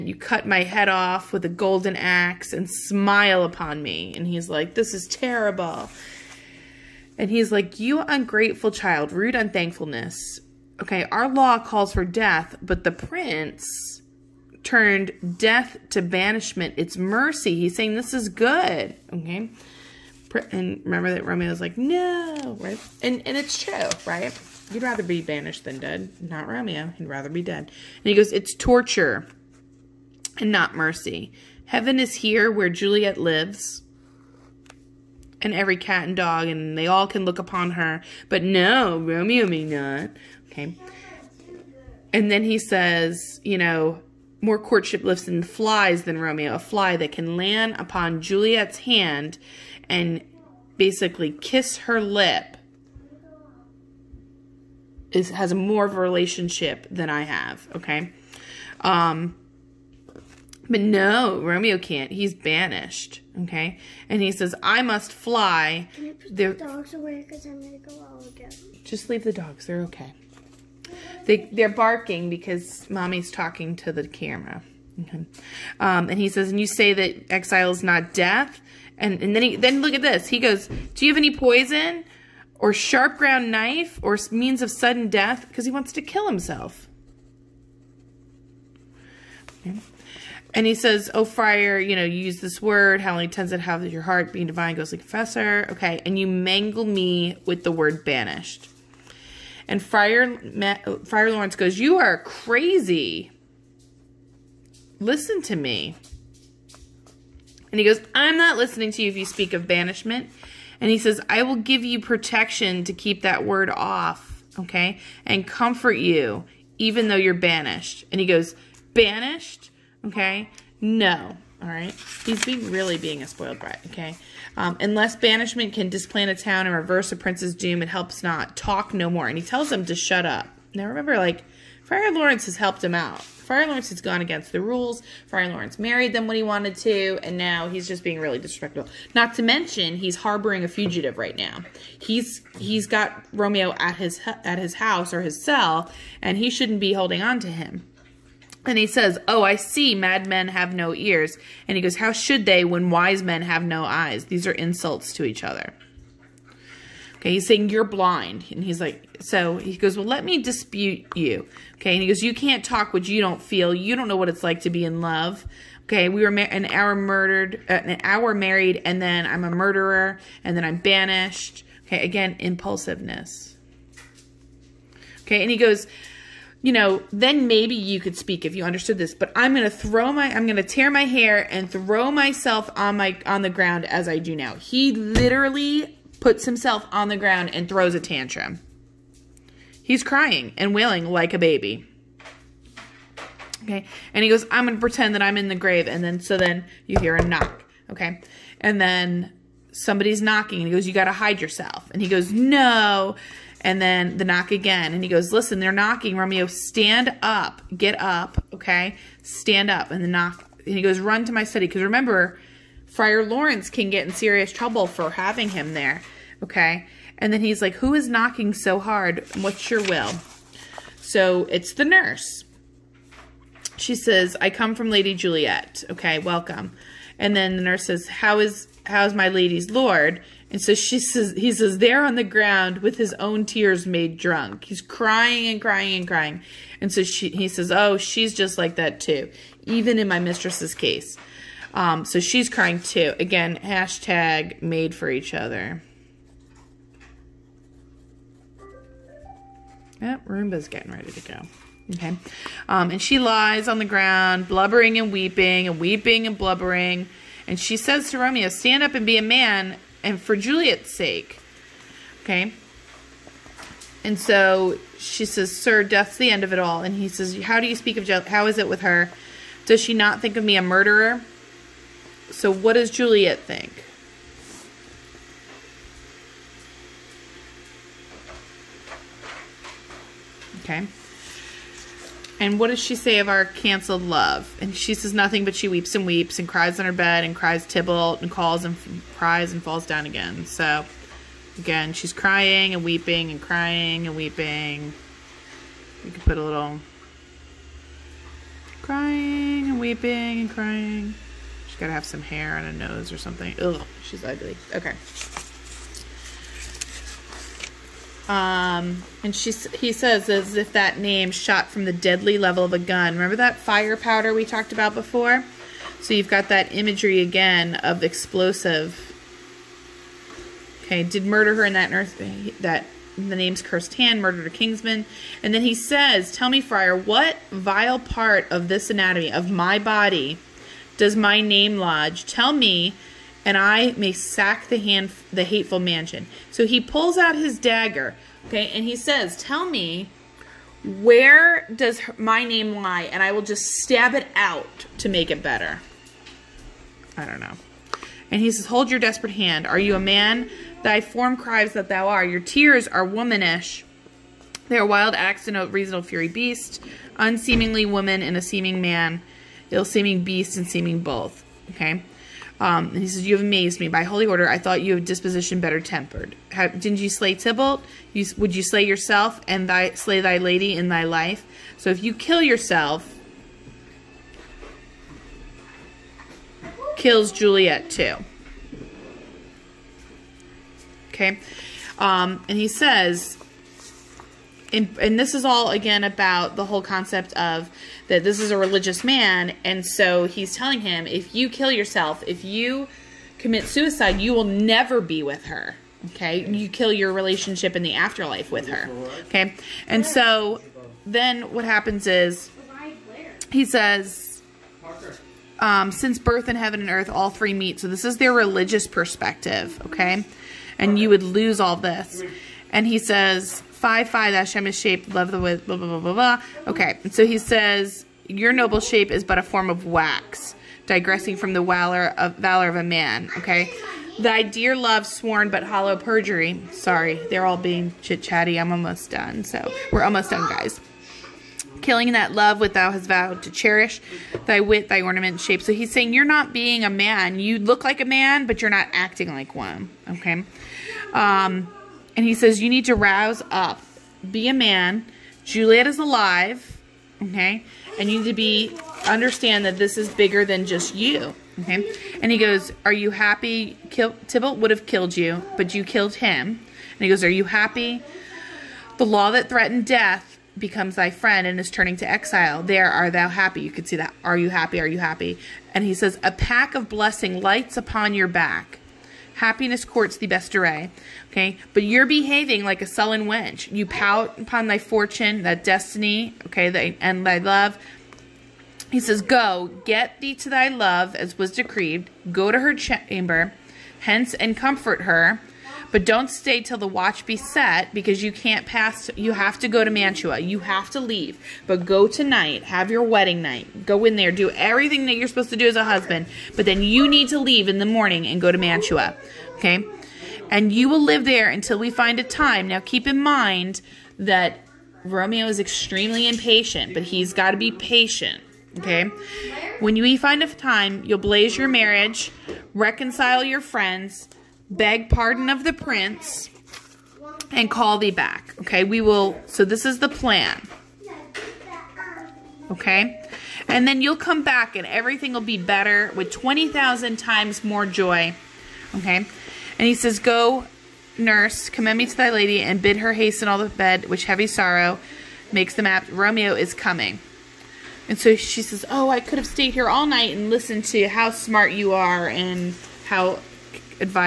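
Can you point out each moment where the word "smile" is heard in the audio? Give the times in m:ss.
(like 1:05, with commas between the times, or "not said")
0:02.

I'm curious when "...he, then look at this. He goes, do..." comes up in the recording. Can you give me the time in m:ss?
1:19.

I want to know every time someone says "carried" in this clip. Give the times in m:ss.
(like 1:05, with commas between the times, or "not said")
not said.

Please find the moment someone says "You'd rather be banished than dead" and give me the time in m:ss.
0:24.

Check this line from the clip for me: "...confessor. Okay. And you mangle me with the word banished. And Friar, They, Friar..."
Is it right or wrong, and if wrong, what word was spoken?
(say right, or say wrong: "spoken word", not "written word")
wrong: "Matt", not "They".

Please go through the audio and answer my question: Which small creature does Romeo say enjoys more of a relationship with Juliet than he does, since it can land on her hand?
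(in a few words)
A fly.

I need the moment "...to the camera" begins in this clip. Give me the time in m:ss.
1:13.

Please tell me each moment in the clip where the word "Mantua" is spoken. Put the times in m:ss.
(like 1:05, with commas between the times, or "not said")
8:09, 8:18.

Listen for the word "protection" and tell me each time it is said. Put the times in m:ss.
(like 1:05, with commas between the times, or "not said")
1:51.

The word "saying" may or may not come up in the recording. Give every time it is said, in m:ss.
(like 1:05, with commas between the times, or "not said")
0:17, 2:37, 7:15.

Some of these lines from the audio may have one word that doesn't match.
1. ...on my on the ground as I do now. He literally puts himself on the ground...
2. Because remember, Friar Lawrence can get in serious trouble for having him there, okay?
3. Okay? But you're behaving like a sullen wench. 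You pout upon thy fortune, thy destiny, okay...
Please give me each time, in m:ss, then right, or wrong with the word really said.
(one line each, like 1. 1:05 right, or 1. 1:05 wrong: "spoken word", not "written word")
1. 3:02 right
2. 3:31 right
3. 7:51 right.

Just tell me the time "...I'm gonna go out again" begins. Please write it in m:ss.
1:07.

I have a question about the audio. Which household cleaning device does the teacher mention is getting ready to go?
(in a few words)
Roomba.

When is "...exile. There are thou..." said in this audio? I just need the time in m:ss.
7:42.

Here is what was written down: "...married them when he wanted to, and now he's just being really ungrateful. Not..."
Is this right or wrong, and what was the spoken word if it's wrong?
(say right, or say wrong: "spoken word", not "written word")
wrong: "disrespectful", not "ungrateful".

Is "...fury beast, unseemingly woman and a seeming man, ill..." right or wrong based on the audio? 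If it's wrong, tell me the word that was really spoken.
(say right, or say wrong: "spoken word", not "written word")
right.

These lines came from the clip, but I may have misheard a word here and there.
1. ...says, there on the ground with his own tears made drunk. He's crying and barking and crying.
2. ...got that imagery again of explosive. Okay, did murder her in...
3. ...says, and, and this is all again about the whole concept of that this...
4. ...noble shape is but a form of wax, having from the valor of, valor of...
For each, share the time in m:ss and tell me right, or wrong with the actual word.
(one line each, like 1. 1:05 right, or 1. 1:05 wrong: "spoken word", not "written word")
1. 3:51 wrong: "crying", not "barking"
2. 5:16 right
3. 6:22 right
4. 6:58 wrong: "digressing", not "having".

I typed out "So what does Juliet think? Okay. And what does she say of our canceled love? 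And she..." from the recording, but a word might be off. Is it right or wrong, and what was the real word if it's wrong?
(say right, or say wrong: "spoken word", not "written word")
right.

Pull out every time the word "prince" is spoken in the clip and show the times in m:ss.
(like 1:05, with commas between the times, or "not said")
0:12, 2:07, 8:35.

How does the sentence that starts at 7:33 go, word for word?
Kill, Tybalt would have killed you, but you killed him.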